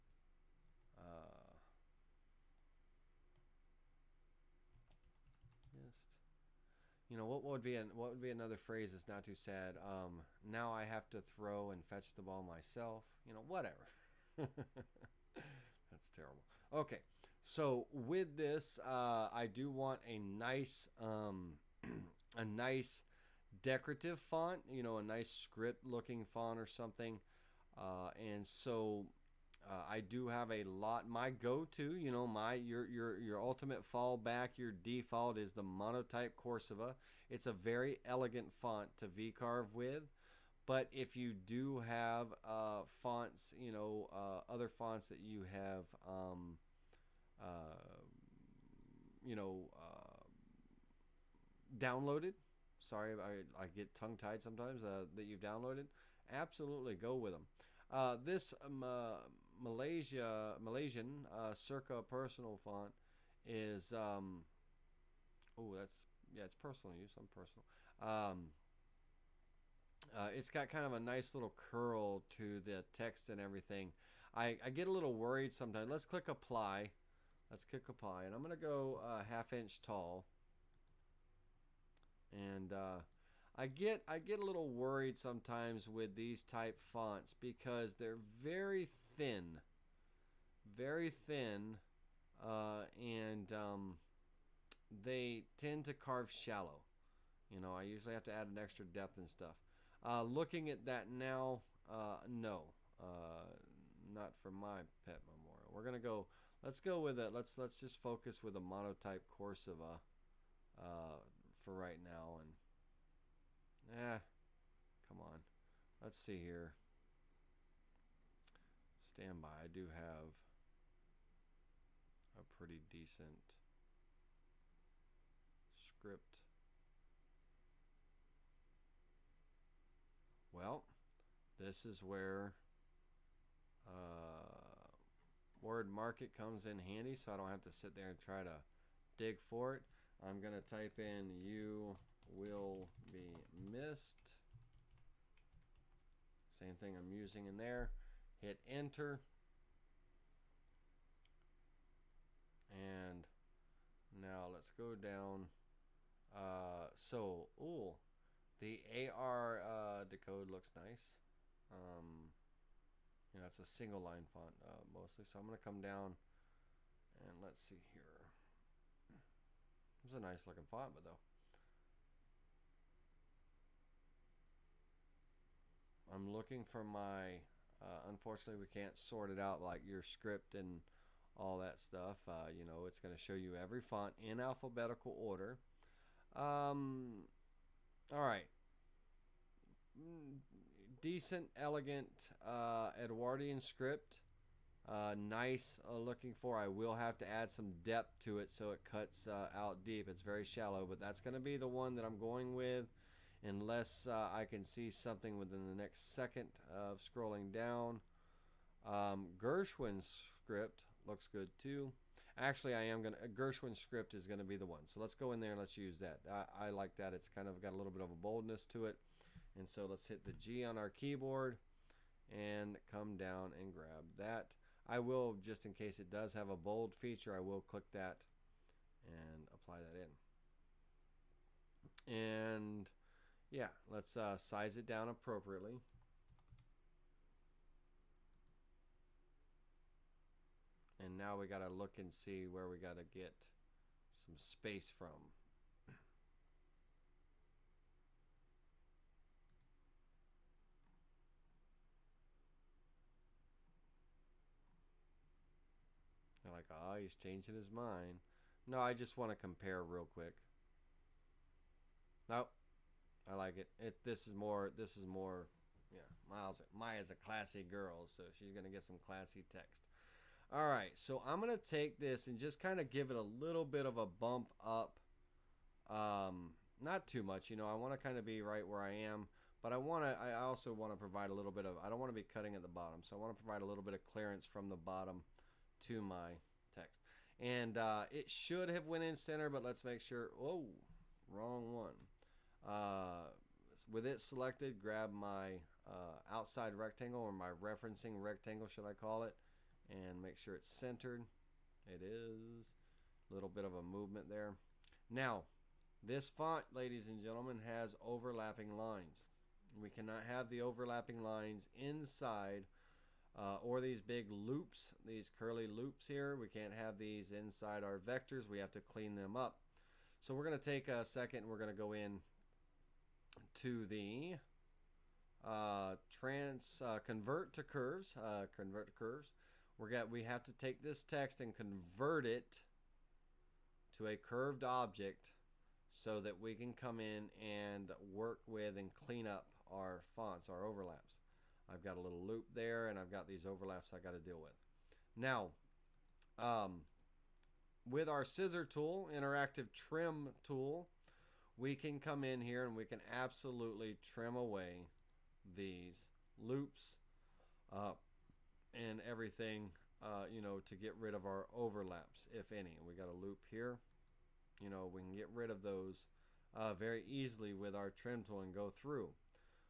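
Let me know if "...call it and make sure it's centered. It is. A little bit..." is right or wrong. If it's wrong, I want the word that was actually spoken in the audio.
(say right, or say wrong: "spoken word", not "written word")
right.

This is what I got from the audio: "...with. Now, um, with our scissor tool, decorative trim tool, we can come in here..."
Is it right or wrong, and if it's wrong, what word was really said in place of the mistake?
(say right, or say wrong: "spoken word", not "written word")
wrong: "interactive", not "decorative".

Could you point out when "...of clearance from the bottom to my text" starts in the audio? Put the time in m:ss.
4:43.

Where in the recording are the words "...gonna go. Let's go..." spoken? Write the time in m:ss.
1:45.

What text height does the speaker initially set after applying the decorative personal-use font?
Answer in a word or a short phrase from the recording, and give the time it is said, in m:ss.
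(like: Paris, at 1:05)
half inch, at 1:19.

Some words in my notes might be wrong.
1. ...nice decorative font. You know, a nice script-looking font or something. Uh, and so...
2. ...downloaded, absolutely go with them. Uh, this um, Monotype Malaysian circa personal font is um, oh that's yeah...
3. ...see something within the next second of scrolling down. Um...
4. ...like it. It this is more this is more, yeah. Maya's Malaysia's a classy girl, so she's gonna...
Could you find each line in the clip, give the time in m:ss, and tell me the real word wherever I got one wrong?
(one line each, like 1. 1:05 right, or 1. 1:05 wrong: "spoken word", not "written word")
1. 0:22 right
2. 0:55 wrong: "Malaysia", not "Monotype"
3. 3:24 right
4. 4:23 wrong: "Maya", not "Malaysia".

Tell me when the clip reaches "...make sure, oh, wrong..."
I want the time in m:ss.
4:49.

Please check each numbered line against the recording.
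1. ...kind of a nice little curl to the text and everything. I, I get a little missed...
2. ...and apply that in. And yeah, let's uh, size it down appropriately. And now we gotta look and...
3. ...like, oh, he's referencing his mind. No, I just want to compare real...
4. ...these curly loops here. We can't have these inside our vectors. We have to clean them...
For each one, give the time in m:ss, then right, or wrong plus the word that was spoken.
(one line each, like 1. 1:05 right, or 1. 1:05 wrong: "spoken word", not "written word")
1. 1:10 wrong: "worried", not "missed"
2. 3:49 right
3. 4:16 wrong: "changing", not "referencing"
4. 5:15 right.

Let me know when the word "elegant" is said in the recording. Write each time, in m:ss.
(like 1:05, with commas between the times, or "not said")
0:38, 3:11.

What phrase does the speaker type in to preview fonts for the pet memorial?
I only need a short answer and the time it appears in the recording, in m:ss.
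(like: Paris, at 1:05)
you will be missed, at 2:21.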